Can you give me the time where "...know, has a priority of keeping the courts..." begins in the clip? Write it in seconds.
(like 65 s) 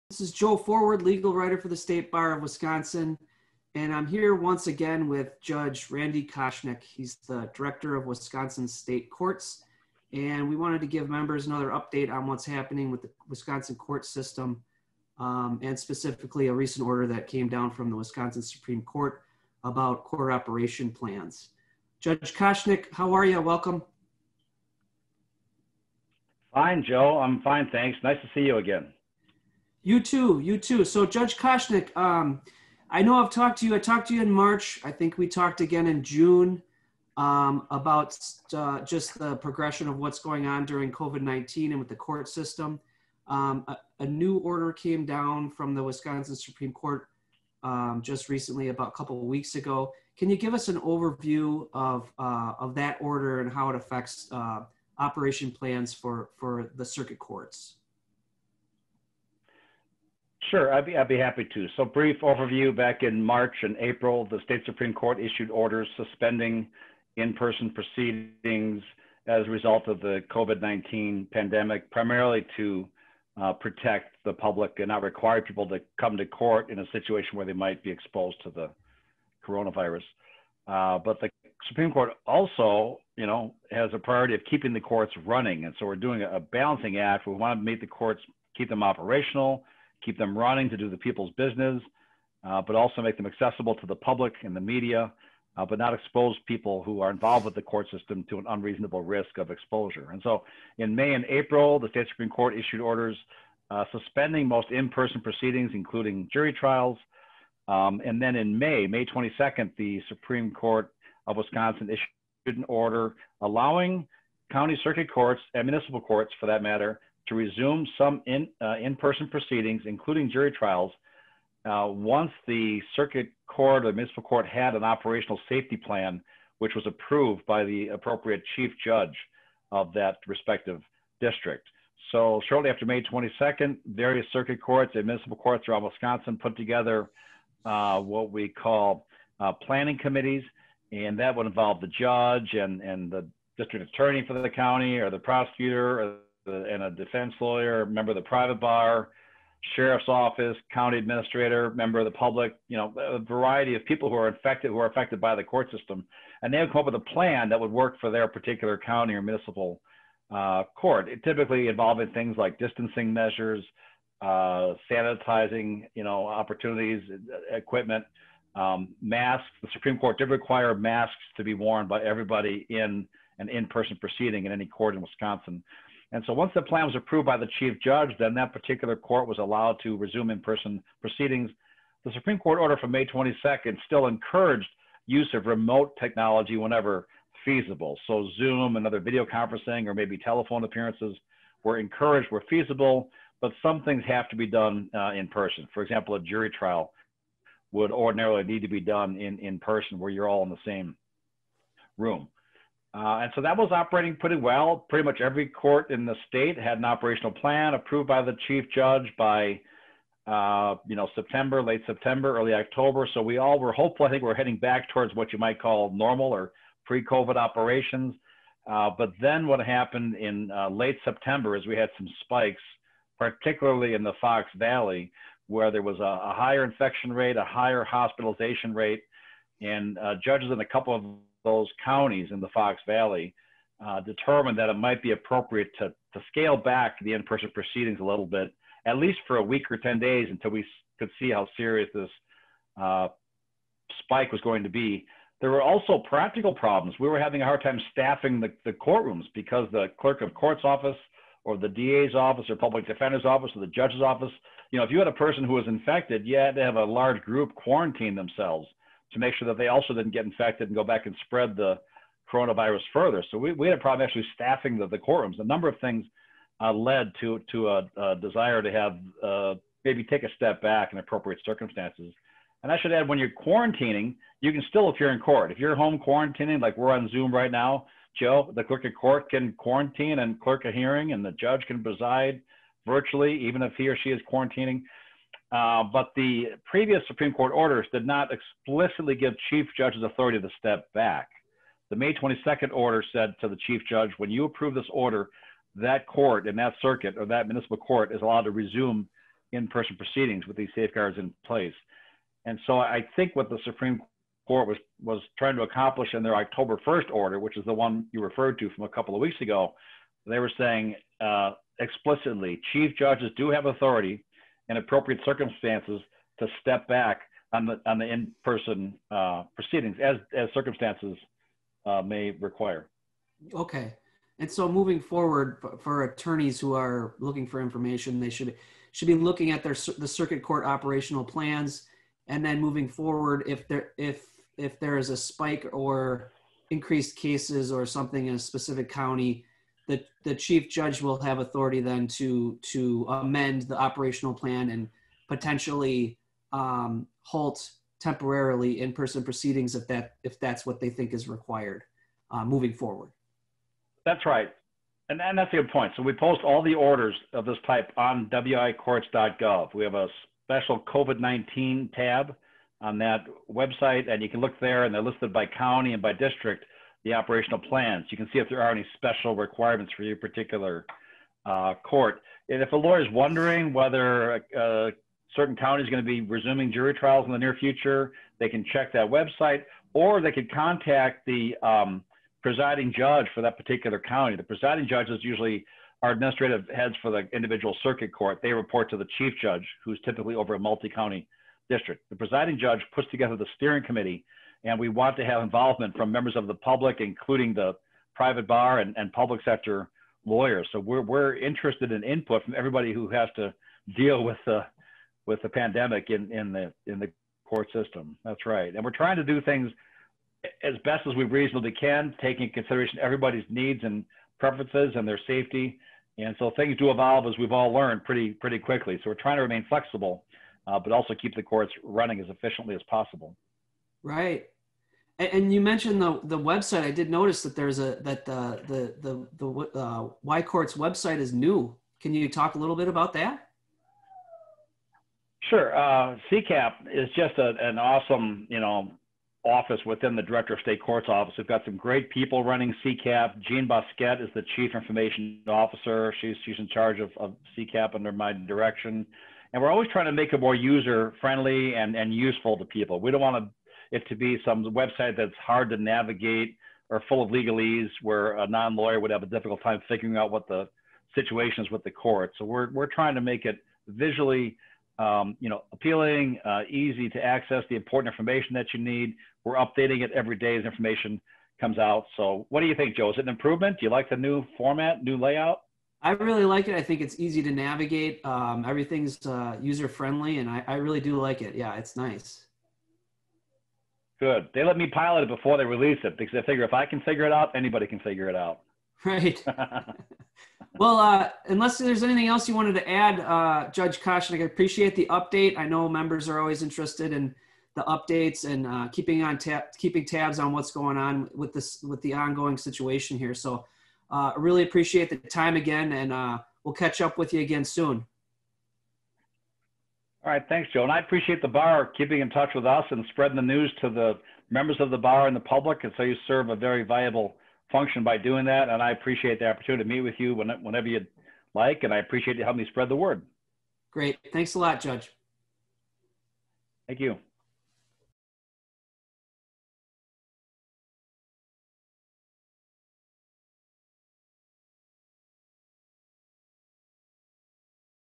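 83 s.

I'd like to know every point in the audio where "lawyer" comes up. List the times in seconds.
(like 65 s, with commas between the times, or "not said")
147 s, 372 s, 400 s, 458 s.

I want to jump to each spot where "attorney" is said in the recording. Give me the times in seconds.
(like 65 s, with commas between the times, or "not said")
143 s, 326 s.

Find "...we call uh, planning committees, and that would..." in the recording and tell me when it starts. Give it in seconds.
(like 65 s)
138 s.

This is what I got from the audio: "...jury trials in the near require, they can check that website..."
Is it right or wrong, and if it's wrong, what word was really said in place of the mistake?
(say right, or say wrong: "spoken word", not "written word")
wrong: "future", not "require".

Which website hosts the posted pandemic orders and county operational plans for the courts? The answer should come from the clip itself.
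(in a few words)
wicourts.gov.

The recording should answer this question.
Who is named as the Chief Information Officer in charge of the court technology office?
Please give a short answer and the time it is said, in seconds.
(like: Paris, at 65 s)
Jean Bousquet, at 443 s.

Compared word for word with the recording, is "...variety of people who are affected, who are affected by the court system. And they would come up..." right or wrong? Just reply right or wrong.
right.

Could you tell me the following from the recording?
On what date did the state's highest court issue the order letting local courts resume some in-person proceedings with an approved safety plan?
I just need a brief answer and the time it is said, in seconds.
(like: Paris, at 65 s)
May 22, at 108 s.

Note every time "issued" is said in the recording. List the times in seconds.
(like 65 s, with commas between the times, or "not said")
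65 s, 102 s, 111 s.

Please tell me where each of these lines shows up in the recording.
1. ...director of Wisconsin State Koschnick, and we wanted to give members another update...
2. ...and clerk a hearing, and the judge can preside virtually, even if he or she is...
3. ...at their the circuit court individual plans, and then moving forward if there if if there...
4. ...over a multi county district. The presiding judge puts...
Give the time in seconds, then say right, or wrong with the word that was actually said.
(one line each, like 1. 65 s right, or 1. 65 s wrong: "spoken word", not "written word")
1. 7 s wrong: "Courts", not "Koschnick"
2. 280 s right
3. 329 s wrong: "operational", not "individual"
4. 390 s right.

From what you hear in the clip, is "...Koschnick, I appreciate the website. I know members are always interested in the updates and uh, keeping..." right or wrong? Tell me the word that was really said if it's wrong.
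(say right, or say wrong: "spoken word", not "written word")
wrong: "update", not "website".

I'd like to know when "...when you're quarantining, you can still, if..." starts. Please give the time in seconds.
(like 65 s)
273 s.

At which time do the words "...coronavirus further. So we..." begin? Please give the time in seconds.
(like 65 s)
262 s.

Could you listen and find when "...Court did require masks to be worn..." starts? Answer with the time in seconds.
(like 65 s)
169 s.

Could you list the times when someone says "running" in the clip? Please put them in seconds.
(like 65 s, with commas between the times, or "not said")
85 s, 90 s, 421 s, 442 s.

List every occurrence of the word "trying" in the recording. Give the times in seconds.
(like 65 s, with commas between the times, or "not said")
305 s, 408 s, 419 s, 449 s, 462 s.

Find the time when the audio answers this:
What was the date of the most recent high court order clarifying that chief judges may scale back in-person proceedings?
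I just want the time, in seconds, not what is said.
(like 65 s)
306 s.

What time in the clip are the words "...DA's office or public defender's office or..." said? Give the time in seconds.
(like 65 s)
251 s.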